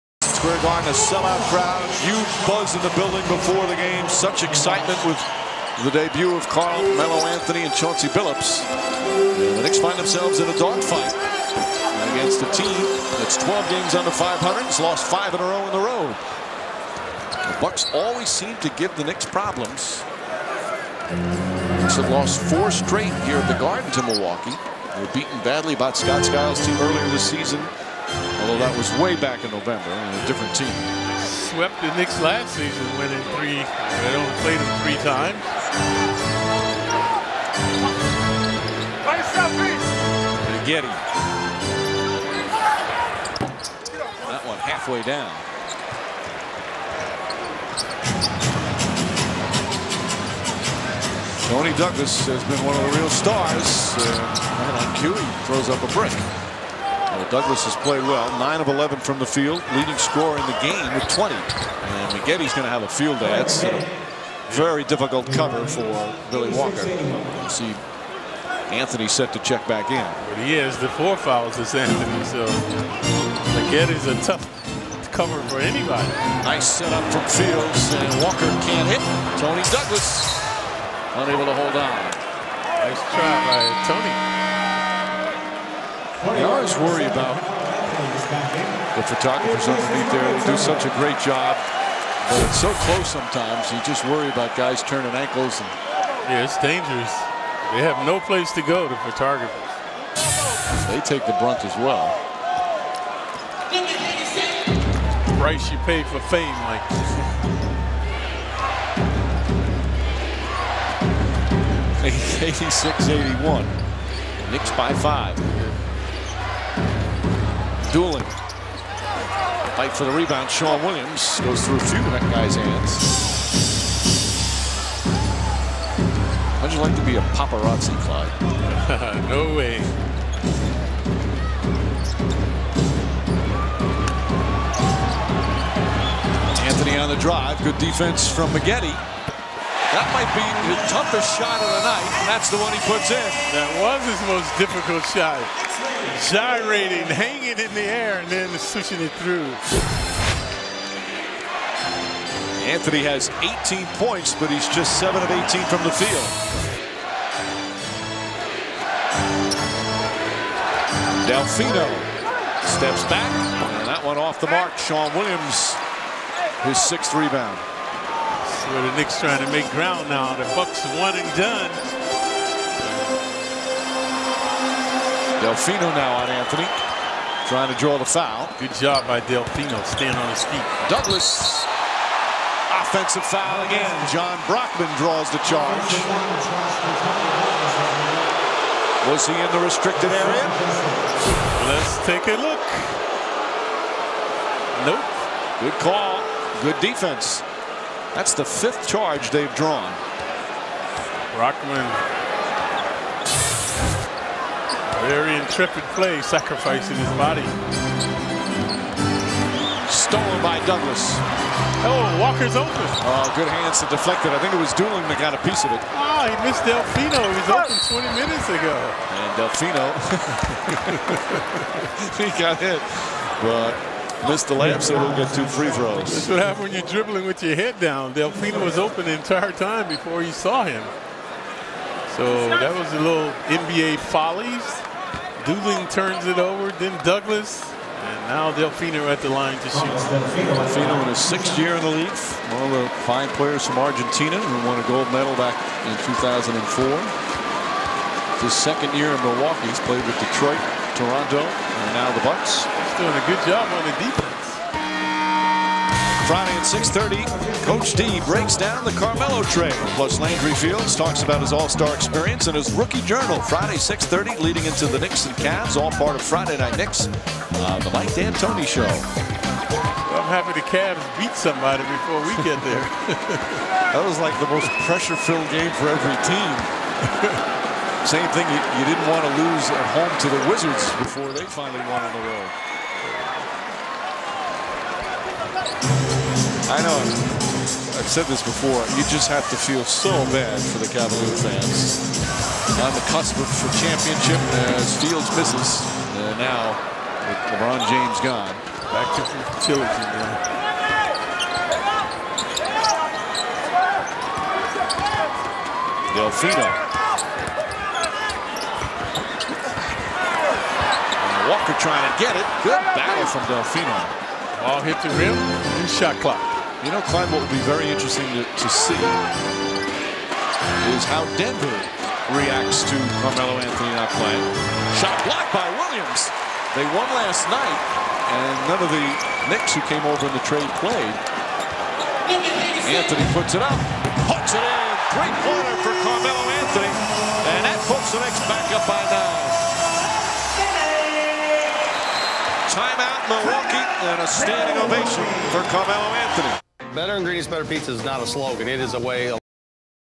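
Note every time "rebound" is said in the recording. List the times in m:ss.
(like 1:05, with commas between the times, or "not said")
2:00, 2:47.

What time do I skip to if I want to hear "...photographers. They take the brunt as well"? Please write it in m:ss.
1:38.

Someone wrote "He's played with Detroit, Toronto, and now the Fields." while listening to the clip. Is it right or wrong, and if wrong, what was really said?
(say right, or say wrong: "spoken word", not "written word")
wrong: "Bucks", not "Fields".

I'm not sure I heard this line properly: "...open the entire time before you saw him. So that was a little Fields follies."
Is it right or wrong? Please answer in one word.
wrong.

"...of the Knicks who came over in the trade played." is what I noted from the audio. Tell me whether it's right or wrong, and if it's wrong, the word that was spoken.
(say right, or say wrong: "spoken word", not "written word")
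right.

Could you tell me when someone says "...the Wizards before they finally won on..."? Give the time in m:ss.
4:40.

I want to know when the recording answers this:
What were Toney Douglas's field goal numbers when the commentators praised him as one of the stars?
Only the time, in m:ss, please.
0:58.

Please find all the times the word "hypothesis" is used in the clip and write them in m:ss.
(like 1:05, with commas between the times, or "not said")
not said.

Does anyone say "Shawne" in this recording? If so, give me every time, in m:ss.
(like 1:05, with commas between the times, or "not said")
2:00, 2:44.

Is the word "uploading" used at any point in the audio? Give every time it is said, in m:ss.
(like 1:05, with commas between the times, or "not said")
not said.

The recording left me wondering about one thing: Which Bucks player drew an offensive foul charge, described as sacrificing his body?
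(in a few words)
Jon Brockman.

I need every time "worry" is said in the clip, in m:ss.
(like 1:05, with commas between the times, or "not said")
1:26, 1:34.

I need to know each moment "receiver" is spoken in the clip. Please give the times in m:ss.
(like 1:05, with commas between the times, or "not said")
not said.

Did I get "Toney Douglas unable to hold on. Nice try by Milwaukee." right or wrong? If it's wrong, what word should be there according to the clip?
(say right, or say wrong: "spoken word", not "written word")
wrong: "Toney", not "Milwaukee".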